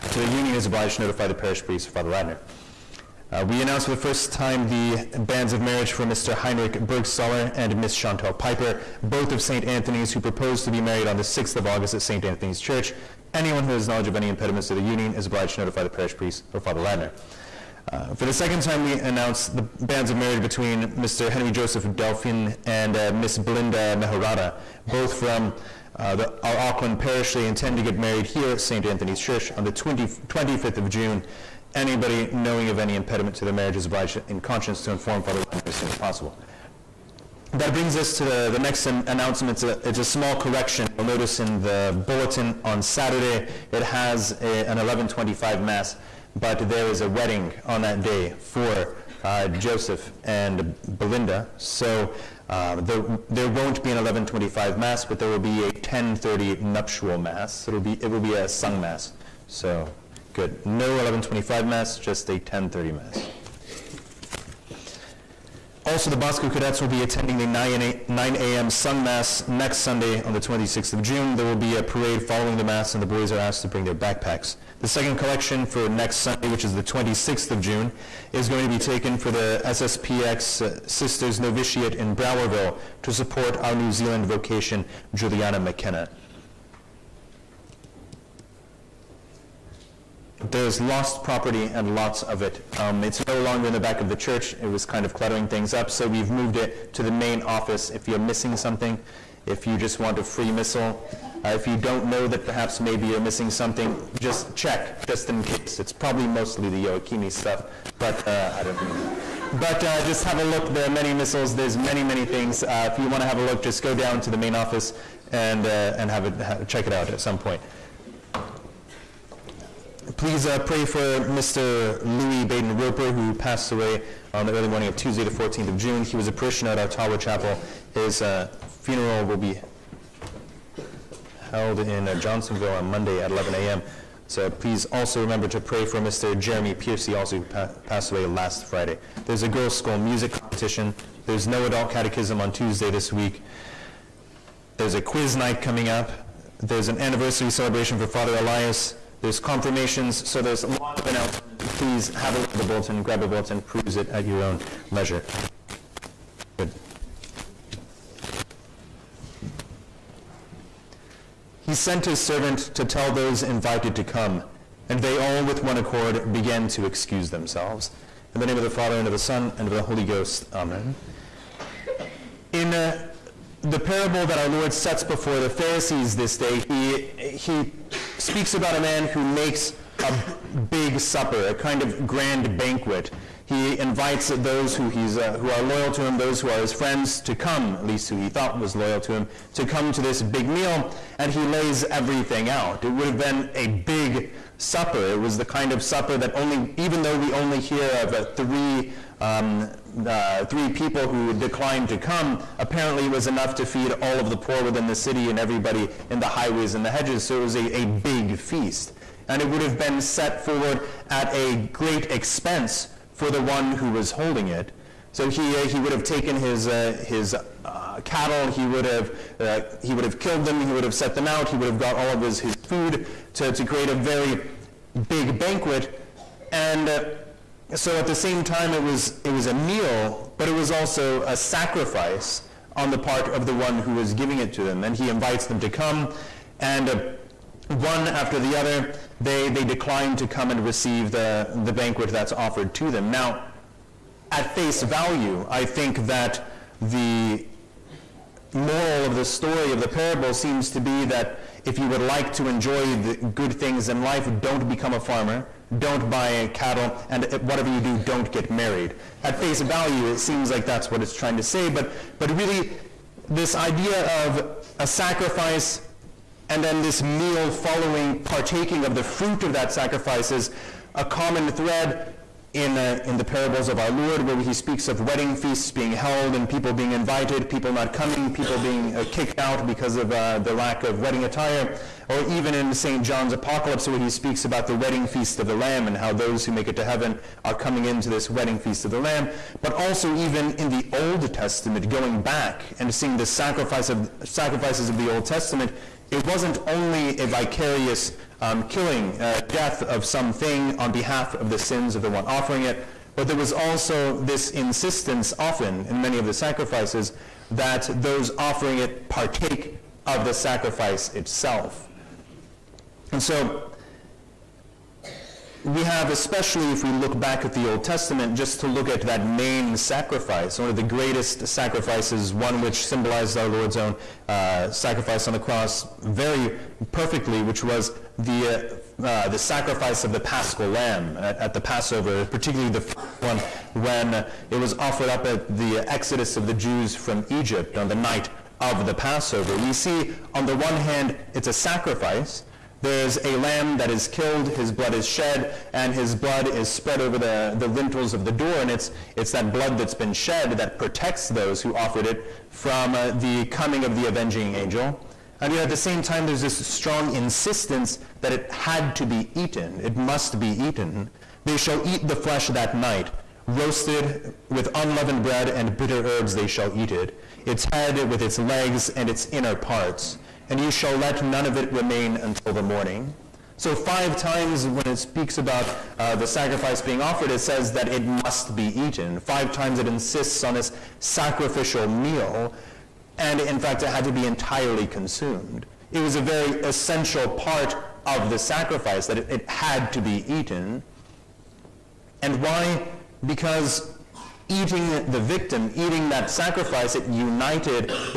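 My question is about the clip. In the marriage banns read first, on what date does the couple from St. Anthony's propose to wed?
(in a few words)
6th of August.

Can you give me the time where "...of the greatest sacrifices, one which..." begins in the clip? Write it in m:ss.
5:20.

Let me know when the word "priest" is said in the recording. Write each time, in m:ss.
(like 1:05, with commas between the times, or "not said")
0:01, 0:16.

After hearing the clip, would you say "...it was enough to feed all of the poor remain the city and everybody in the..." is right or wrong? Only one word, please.
wrong.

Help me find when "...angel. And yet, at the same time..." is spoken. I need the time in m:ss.
5:54.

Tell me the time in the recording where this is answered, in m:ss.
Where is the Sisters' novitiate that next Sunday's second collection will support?
1:22.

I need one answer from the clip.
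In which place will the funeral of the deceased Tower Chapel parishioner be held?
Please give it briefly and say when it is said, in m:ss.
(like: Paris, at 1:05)
Johnsonville, at 2:12.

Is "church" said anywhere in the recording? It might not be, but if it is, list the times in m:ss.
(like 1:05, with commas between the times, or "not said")
0:12, 0:29, 1:34.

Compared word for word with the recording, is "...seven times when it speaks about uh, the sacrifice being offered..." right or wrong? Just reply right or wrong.
wrong.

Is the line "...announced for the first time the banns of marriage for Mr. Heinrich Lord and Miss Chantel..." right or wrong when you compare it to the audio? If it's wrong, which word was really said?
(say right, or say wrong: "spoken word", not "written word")
wrong: "Bergstaller", not "Lord".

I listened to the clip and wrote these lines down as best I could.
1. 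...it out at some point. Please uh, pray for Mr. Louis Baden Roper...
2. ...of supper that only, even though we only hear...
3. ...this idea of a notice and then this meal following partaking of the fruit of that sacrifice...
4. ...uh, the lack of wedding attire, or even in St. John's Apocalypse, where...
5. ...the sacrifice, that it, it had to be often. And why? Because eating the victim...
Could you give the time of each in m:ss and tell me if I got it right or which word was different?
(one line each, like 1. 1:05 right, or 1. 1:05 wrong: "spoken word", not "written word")
1. 1:56 right
2. 3:15 right
3. 4:23 wrong: "sacrifice", not "notice"
4. 4:40 right
5. 6:28 wrong: "eaten", not "often".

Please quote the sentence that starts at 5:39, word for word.
We see, on the one hand, it's a sacrifice.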